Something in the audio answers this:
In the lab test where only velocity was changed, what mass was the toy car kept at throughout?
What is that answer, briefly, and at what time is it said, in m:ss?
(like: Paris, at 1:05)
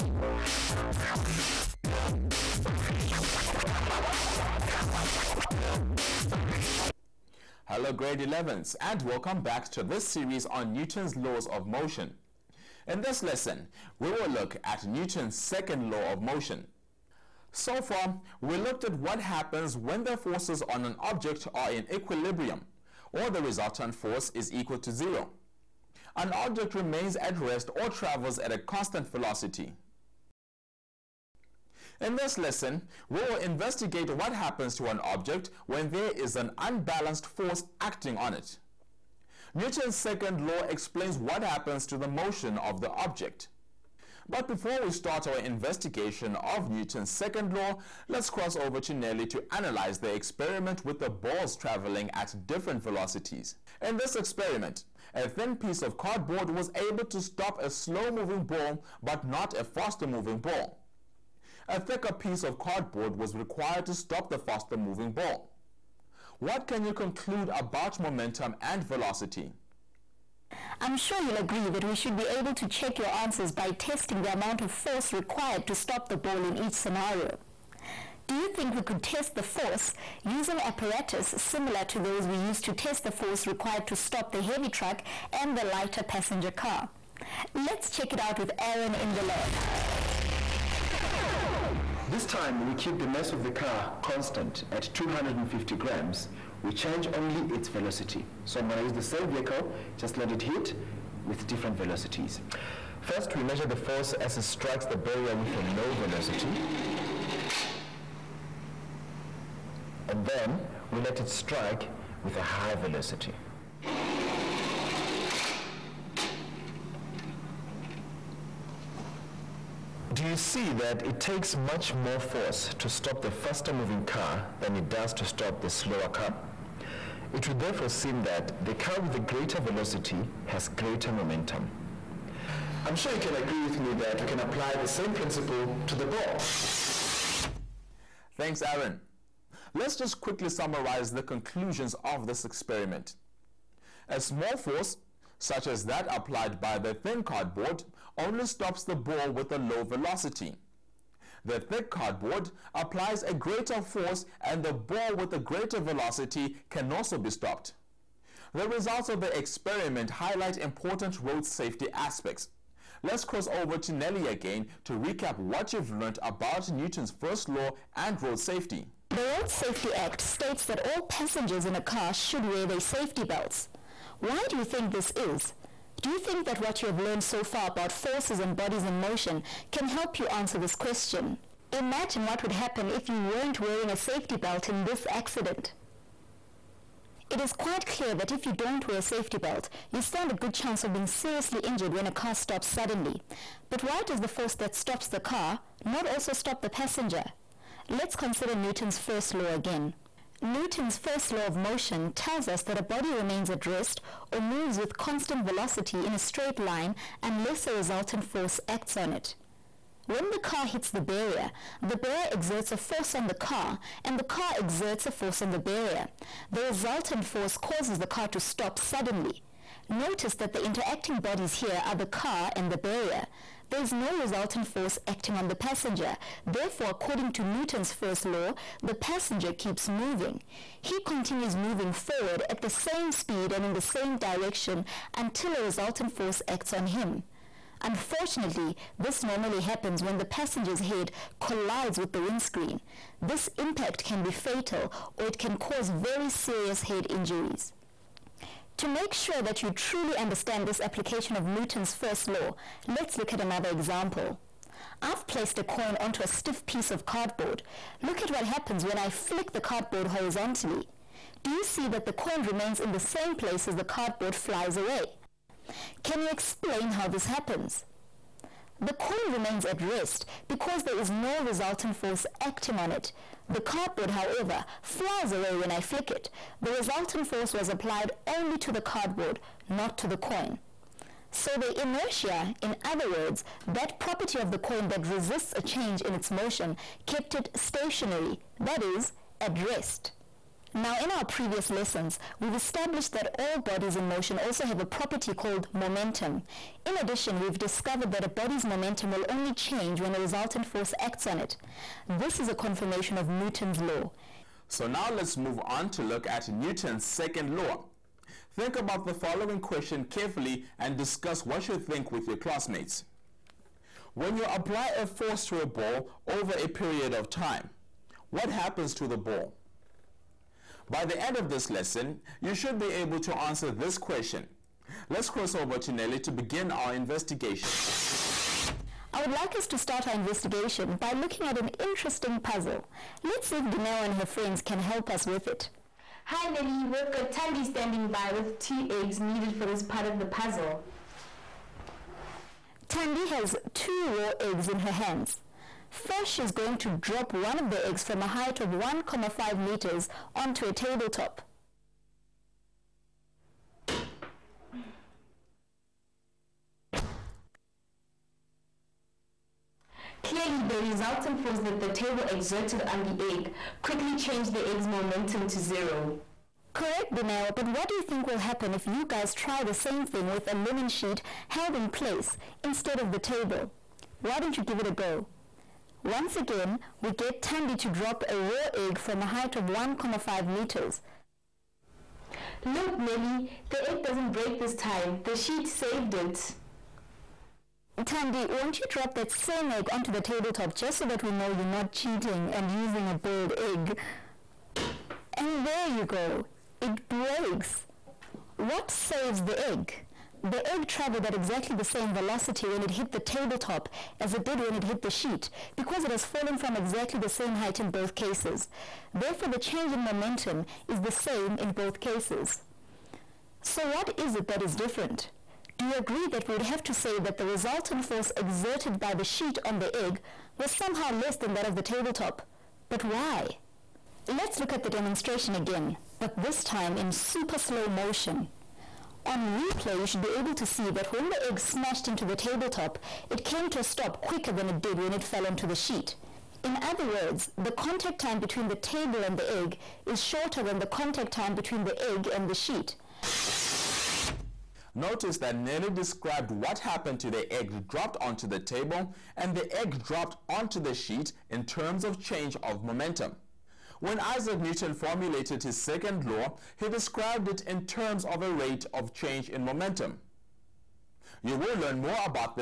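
250 grams, at 1:34.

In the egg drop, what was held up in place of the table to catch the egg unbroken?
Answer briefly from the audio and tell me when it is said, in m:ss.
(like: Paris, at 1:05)
A linen sheet, at 6:10.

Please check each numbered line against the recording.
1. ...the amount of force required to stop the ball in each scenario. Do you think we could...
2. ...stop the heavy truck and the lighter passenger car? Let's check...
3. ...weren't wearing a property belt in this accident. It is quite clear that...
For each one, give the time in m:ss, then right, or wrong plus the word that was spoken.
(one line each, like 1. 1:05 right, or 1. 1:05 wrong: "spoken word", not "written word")
1. 1:14 right
2. 1:23 right
3. 3:03 wrong: "safety", not "property".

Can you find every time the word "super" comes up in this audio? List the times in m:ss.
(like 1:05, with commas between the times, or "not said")
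7:07.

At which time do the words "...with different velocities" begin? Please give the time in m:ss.
1:41.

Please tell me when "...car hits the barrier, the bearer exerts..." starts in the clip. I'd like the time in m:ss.
3:30.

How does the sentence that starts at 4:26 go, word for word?
Can you explain how this happens?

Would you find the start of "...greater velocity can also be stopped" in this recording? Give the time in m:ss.
2:35.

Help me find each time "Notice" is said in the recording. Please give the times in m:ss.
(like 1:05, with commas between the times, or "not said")
3:39, 7:24.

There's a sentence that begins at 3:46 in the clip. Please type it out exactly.
Therefore, according to Newton's first law, the passenger keeps moving.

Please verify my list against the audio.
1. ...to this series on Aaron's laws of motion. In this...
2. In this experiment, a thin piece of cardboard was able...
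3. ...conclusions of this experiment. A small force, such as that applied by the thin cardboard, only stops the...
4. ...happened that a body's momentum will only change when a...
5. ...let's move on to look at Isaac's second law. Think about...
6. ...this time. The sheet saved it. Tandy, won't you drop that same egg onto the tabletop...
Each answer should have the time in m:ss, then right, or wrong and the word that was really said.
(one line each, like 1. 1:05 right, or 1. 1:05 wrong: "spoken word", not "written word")
1. 0:09 wrong: "Newton", not "Aaron"
2. 0:53 right
3. 2:21 right
4. 4:57 wrong: "discovered", not "happened"
5. 5:05 wrong: "Newton", not "Isaac"
6. 6:24 right.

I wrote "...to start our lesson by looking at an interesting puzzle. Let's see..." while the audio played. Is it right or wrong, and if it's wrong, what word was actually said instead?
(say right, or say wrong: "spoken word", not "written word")
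wrong: "investigation", not "lesson".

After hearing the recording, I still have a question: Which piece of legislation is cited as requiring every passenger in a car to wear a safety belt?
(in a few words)
Road Safety Act.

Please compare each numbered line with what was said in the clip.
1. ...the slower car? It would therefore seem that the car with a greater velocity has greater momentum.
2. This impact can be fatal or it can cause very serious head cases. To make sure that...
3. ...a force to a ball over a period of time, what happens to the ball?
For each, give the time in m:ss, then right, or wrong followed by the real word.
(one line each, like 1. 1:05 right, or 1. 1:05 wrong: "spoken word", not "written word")
1. 2:05 right
2. 4:03 wrong: "injuries", not "cases"
3. 5:14 right.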